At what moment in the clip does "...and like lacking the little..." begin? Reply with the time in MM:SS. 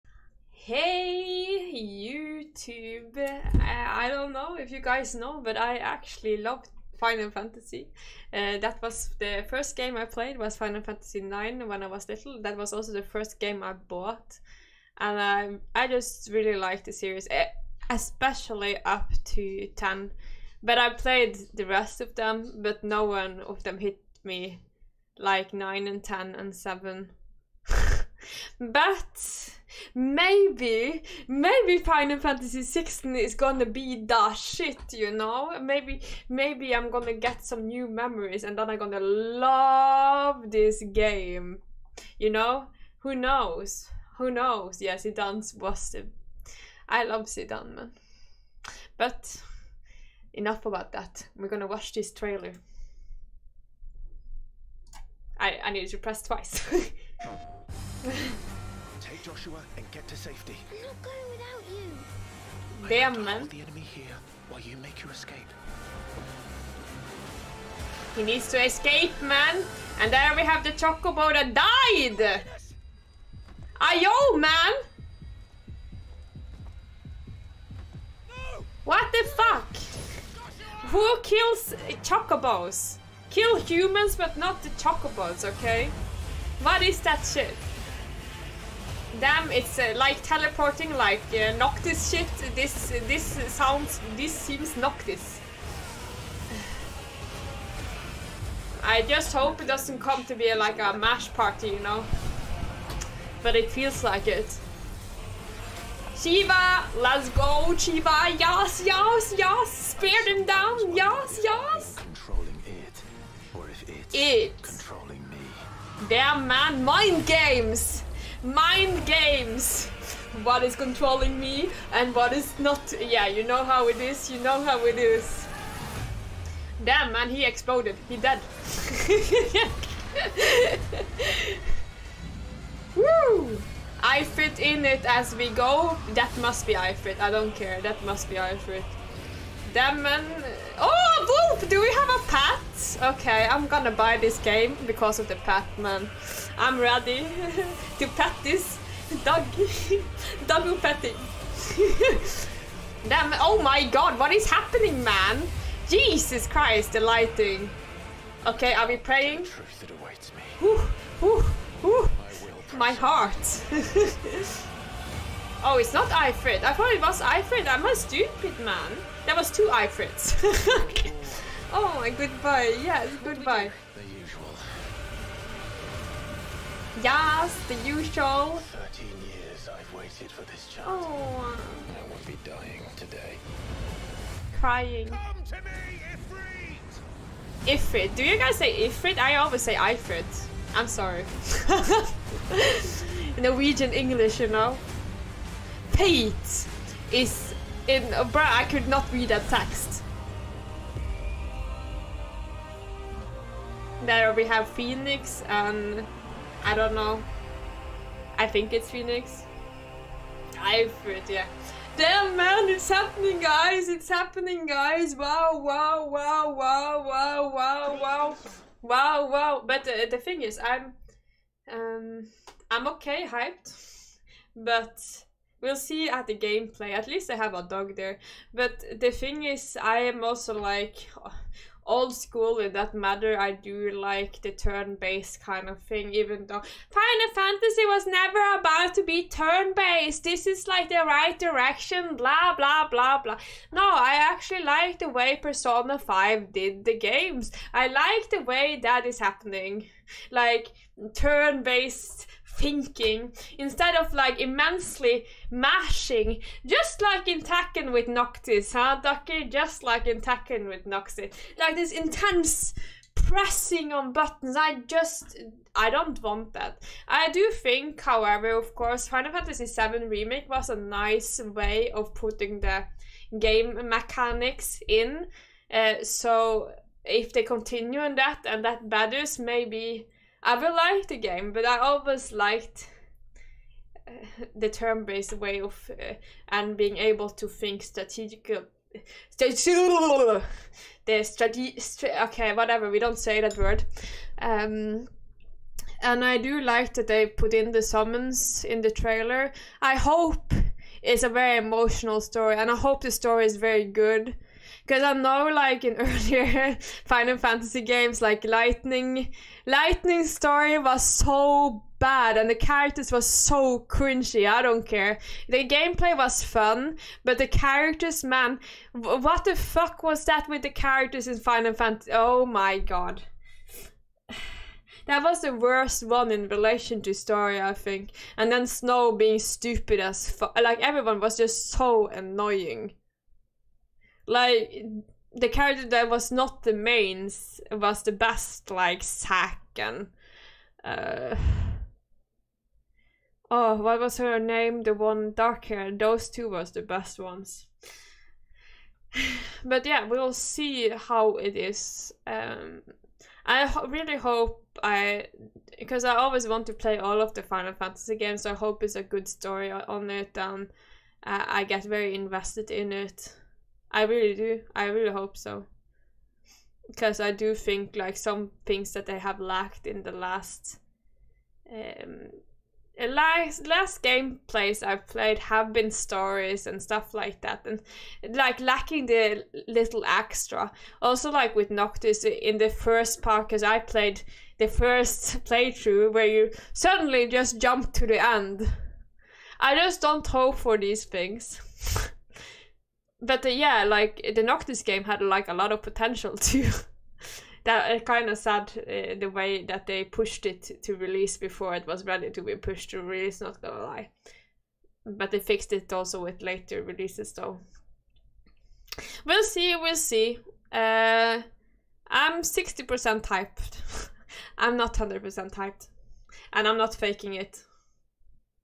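06:17.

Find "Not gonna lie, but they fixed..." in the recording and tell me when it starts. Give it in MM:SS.
06:43.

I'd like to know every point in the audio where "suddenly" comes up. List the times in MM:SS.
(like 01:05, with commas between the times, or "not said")
06:26.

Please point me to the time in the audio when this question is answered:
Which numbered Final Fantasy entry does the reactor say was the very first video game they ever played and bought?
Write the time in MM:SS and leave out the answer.
00:10.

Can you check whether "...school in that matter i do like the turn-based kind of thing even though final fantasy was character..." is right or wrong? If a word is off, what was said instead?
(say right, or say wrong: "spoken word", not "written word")
wrong: "never", not "character".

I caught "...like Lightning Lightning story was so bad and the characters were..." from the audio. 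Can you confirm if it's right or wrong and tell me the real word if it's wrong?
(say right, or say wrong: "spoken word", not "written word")
right.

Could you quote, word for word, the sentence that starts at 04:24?
I just I don't want that.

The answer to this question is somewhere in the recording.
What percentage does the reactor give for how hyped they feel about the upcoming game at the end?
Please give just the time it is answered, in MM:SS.
06:52.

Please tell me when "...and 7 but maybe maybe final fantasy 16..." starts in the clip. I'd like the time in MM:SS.
00:26.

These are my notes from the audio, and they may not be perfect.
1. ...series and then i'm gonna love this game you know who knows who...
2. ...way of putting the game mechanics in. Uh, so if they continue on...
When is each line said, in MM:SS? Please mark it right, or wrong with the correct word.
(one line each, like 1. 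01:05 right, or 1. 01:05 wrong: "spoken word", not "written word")
1. 00:37 wrong: "memories", not "series"
2. 04:31 right.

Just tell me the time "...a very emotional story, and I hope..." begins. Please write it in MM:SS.
05:01.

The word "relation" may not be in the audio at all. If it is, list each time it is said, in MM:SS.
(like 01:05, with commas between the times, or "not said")
05:26.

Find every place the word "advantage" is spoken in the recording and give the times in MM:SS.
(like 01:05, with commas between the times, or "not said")
not said.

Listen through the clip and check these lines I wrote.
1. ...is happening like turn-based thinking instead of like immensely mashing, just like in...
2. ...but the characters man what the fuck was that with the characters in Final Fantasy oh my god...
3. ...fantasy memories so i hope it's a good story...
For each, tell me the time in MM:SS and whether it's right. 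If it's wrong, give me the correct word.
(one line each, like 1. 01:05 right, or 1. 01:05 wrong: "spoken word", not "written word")
1. 04:09 right
2. 05:17 right
3. 05:57 wrong: "games", not "memories".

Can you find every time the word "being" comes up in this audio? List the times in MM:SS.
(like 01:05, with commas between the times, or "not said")
04:46, 05:29.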